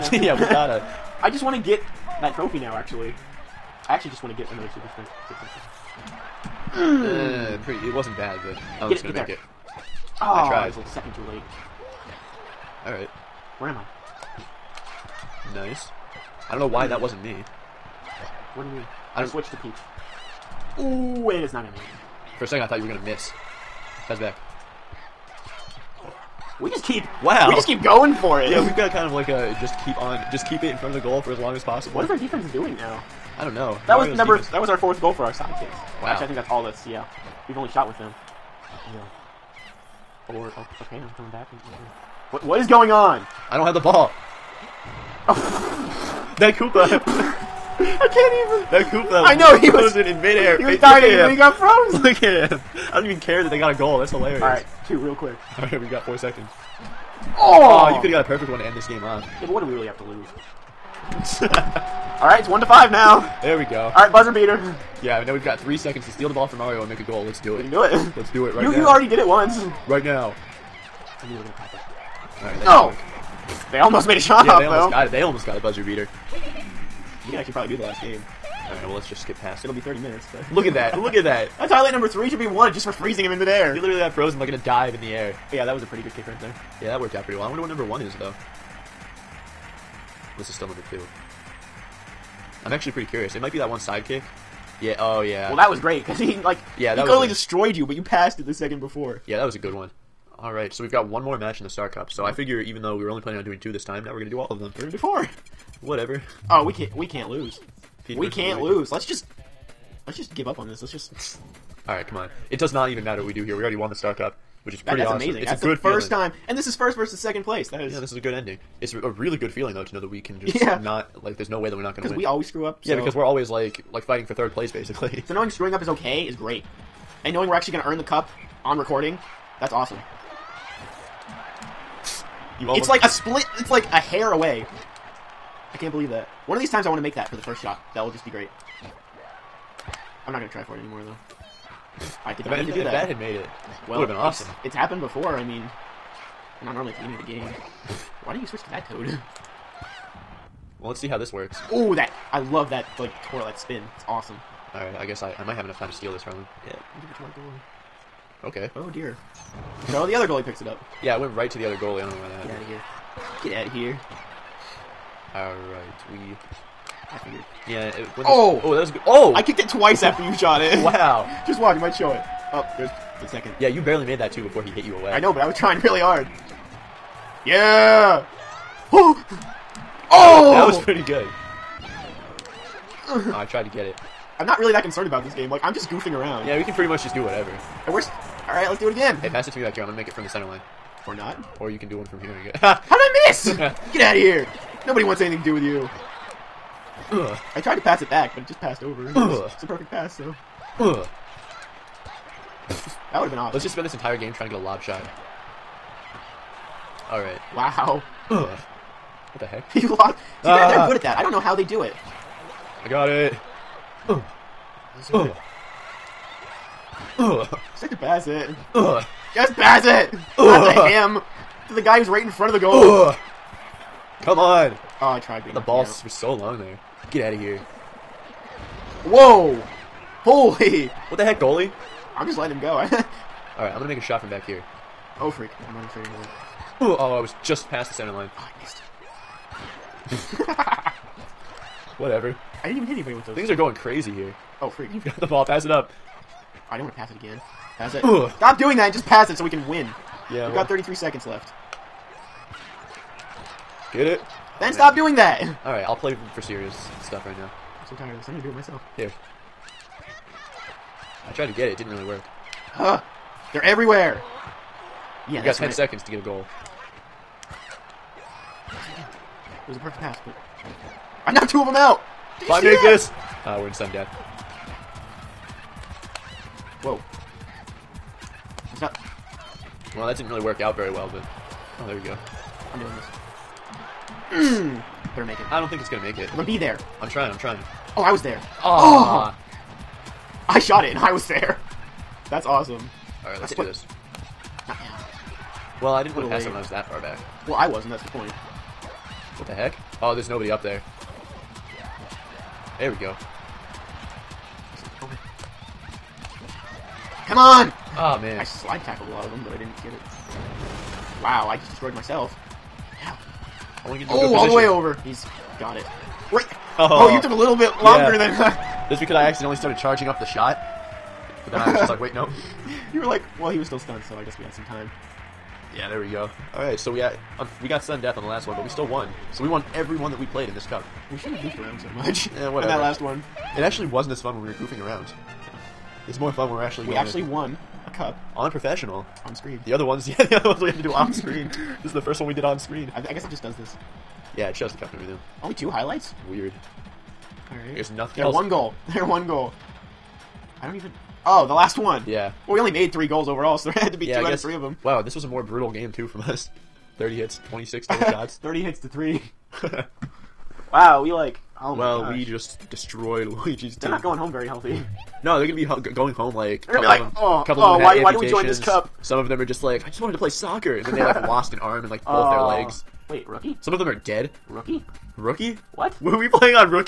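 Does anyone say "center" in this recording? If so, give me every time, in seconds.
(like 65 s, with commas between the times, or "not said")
190 s, 237 s.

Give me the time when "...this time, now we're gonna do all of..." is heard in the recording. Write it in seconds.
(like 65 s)
103 s.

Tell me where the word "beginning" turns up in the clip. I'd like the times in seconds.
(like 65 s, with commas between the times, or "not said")
147 s.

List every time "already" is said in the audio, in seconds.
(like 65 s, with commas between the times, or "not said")
68 s, 113 s.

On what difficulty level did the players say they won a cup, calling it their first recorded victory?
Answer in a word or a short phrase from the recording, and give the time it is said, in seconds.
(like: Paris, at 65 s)
professional, at 338 s.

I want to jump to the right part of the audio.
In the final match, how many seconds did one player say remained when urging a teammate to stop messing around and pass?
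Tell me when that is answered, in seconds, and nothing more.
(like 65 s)
250 s.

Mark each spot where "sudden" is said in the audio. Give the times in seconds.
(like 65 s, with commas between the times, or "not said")
327 s.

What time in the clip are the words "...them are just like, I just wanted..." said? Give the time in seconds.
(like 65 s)
369 s.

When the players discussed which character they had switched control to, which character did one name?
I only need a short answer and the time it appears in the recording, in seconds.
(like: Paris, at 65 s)
Peach, at 19 s.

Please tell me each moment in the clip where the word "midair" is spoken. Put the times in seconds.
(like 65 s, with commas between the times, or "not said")
50 s, 83 s.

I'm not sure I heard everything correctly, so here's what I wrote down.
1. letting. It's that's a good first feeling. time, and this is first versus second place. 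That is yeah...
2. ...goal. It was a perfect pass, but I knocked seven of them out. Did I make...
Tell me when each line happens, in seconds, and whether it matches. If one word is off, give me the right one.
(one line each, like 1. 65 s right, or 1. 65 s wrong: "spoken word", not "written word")
1. 115 s wrong: "amazing", not "letting"
2. 266 s wrong: "two", not "seven".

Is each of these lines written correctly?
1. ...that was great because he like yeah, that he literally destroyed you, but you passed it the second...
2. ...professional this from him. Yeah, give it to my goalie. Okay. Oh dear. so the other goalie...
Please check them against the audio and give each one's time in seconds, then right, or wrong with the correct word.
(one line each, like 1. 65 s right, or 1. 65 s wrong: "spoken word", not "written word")
1. 95 s wrong: "totally", not "literally"
2. 155 s wrong: "steal", not "professional".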